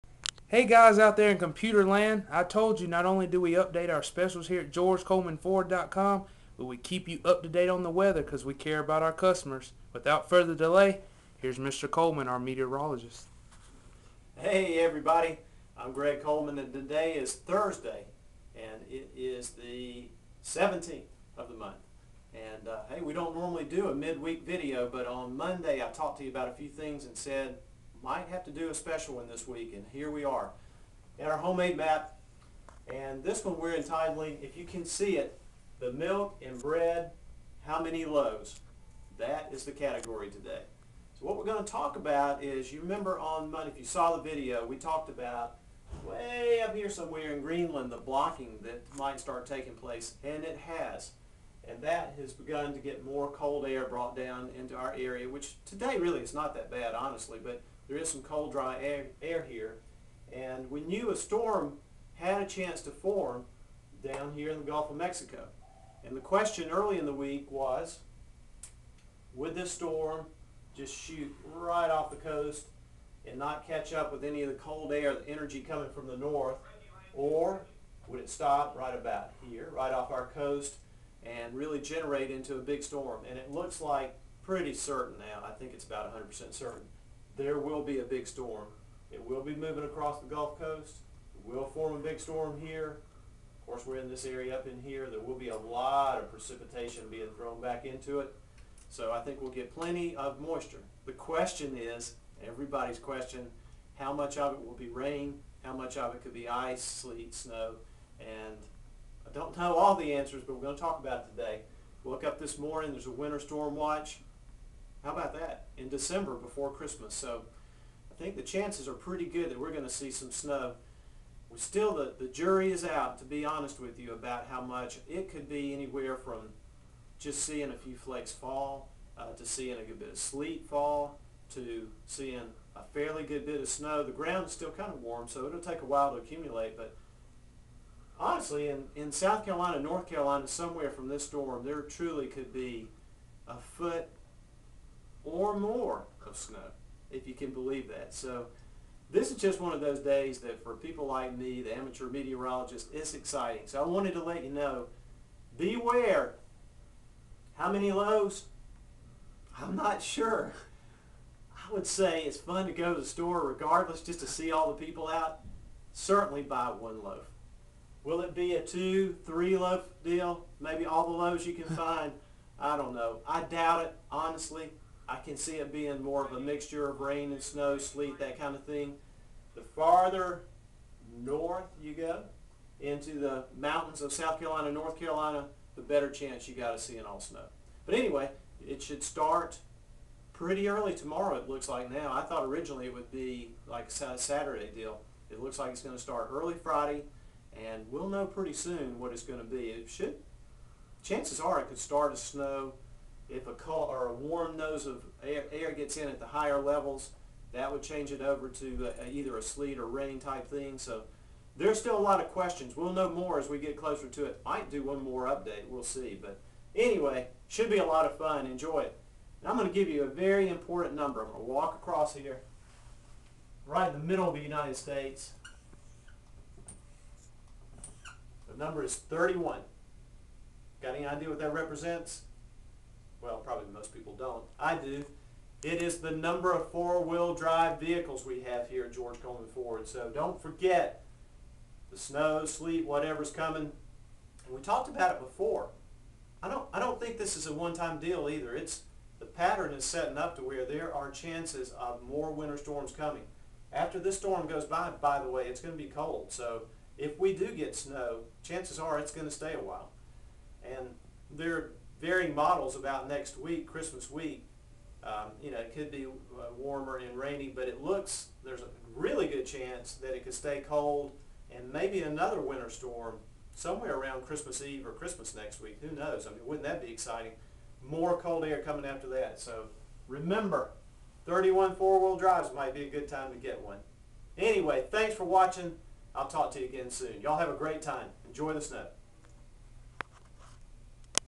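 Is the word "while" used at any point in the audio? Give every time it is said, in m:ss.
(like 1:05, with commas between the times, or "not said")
2:15, 4:19.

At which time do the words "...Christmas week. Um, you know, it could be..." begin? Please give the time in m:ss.
4:23.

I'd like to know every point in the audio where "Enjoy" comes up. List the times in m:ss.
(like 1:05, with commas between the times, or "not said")
3:38, 4:48.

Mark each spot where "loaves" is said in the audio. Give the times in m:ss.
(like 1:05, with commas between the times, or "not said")
0:38, 2:51.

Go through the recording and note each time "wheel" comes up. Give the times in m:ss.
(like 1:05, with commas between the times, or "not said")
3:56, 4:41.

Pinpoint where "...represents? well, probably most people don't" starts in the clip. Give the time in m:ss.
3:51.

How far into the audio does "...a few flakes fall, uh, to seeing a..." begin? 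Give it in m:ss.
2:07.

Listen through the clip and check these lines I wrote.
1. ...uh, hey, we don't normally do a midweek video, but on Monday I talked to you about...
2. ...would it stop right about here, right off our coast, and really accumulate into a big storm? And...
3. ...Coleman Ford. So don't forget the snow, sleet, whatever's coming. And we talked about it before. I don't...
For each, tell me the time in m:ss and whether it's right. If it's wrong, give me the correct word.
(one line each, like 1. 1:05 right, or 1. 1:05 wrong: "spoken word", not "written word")
1. 0:22 right
2. 1:18 wrong: "generate", not "accumulate"
3. 3:59 right.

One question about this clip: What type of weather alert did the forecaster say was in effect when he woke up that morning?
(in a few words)
Winter storm watch.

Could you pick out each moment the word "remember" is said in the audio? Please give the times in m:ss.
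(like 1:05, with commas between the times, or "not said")
0:42, 4:40.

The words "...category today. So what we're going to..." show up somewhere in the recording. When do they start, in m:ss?
0:39.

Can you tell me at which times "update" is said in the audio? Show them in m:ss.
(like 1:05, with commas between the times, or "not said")
0:03, 3:35.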